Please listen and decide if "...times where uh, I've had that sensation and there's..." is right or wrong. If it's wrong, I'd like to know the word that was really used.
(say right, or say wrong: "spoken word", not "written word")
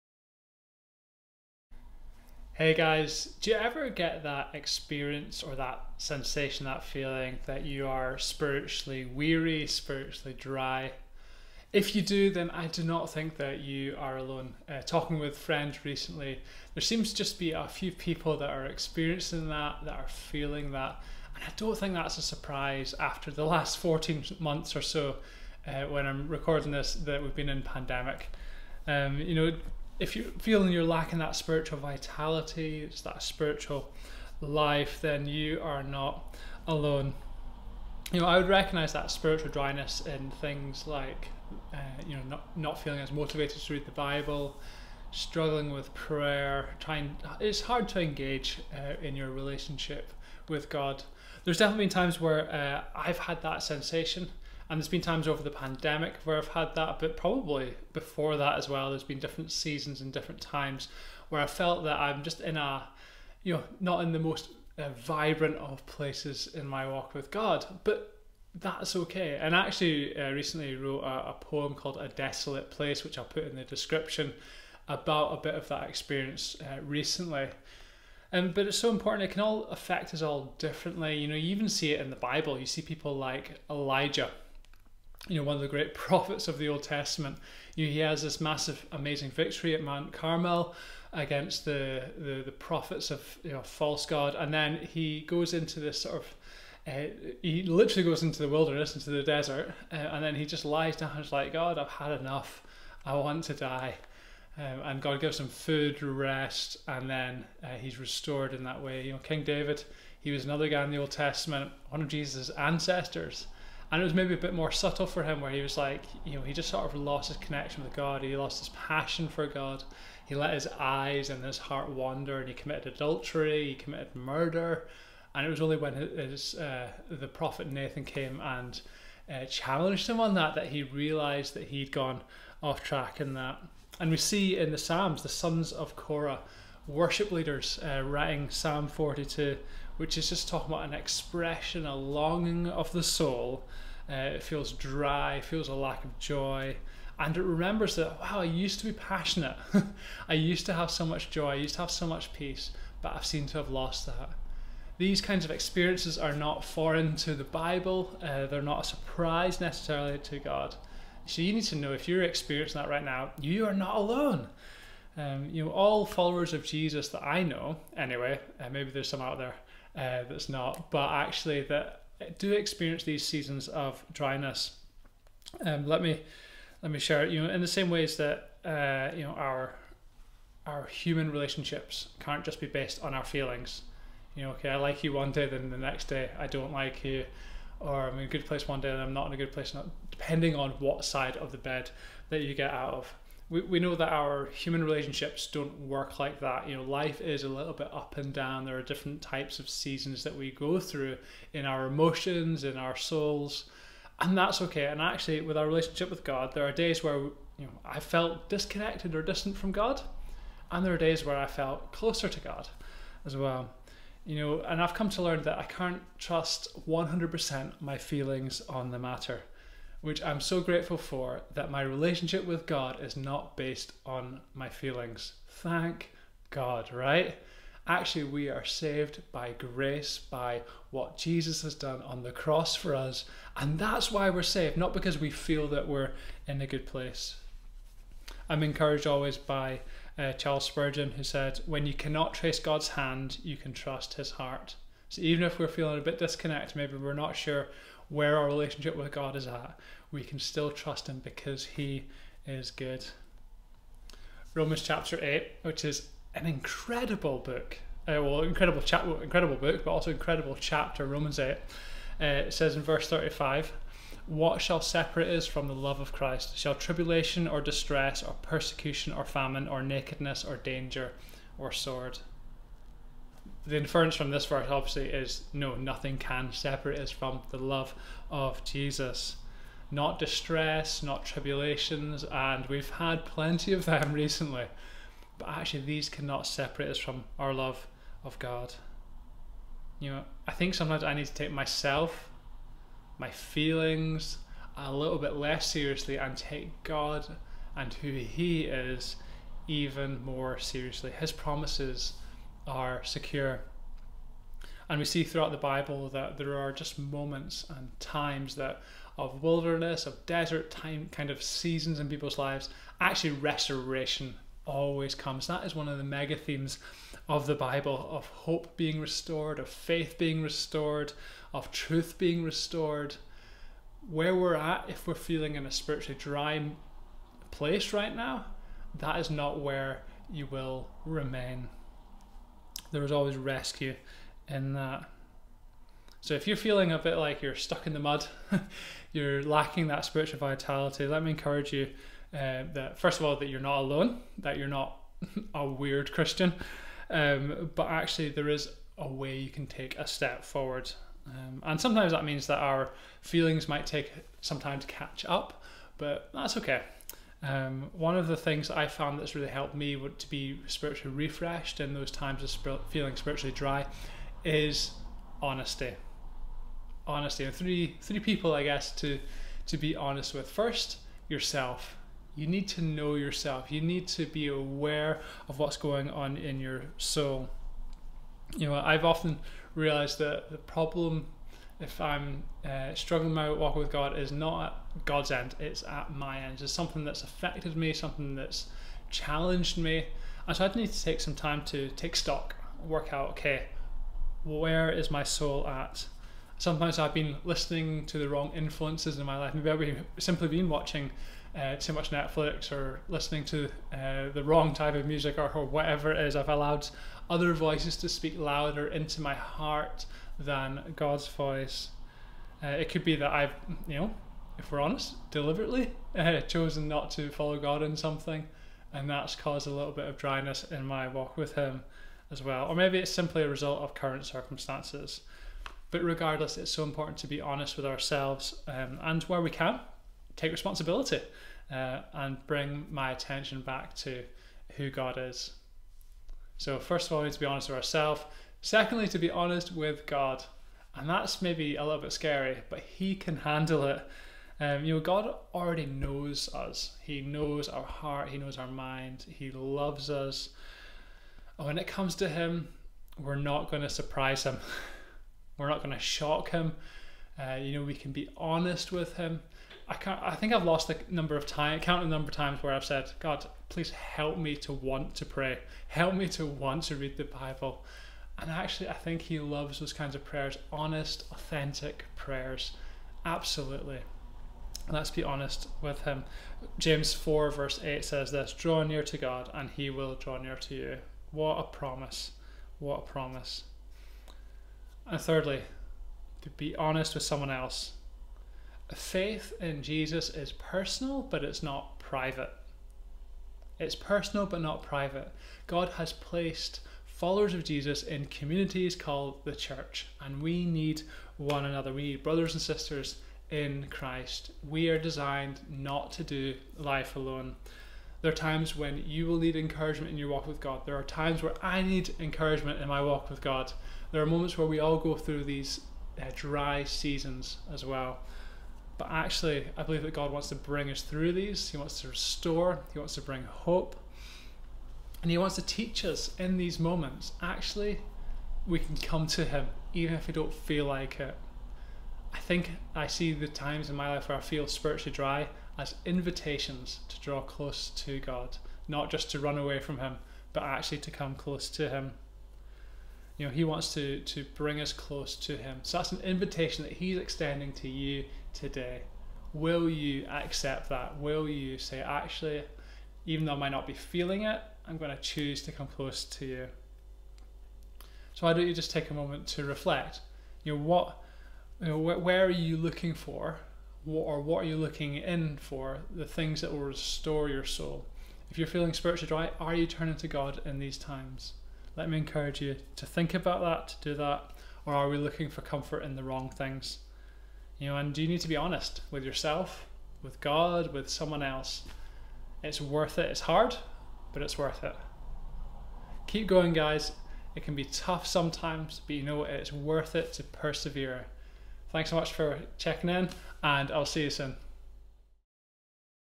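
right.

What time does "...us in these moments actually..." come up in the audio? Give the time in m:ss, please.
8:46.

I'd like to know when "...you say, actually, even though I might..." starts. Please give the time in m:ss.
9:11.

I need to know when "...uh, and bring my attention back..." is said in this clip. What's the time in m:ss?
7:11.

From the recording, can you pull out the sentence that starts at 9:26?
The things that will restore your soul.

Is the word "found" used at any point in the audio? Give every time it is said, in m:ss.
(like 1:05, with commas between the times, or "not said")
5:58.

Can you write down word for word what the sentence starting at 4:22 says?
Uh, it says in verse 35 What shall separate us from the love of Christ?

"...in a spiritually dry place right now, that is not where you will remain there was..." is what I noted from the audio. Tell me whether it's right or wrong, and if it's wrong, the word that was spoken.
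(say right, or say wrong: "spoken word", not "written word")
right.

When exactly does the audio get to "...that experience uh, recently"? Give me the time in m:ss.
1:15.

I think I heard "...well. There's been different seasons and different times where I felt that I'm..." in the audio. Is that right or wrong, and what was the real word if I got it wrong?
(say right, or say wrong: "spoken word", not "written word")
right.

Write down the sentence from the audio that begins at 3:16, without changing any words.
You know, life is a little bit up and down.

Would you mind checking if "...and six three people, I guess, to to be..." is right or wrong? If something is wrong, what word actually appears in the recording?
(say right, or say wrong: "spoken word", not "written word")
wrong: "three", not "six".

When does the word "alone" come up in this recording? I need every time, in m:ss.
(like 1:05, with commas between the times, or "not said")
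0:14, 0:36, 2:43, 5:43, 8:27.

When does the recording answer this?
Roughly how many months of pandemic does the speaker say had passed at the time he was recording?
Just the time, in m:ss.
0:23.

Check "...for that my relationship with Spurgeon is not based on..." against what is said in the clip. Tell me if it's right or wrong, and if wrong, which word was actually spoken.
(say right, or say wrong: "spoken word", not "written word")
wrong: "God", not "Spurgeon".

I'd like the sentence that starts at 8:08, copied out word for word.
Faith in Jesus is personal, but it's not private.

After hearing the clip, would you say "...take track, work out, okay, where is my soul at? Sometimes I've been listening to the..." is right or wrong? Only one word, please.
wrong.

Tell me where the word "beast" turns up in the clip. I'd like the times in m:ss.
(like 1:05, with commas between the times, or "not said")
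not said.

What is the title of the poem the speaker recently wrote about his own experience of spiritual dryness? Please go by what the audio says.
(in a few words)
A Desolate Place.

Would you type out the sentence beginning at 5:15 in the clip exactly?
That is one of the mega themes of the Bible of hope being restored, of faith being restored, of truth being restored.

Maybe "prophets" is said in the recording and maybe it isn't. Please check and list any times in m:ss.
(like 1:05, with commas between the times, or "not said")
1:25, 1:32, 2:07.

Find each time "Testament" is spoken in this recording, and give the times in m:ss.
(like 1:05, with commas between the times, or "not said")
1:26, 1:51.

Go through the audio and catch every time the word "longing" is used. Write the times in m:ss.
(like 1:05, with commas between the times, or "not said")
2:21.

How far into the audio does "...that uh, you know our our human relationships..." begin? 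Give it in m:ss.
2:58.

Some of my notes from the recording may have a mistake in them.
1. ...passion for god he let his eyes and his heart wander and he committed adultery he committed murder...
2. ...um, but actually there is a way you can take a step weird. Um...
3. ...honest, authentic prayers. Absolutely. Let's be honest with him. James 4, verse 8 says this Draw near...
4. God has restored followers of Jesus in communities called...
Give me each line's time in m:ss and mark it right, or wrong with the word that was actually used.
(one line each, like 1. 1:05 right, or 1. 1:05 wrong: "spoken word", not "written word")
1. 1:58 right
2. 5:47 wrong: "forward", not "weird"
3. 7:50 right
4. 8:15 wrong: "placed", not "restored".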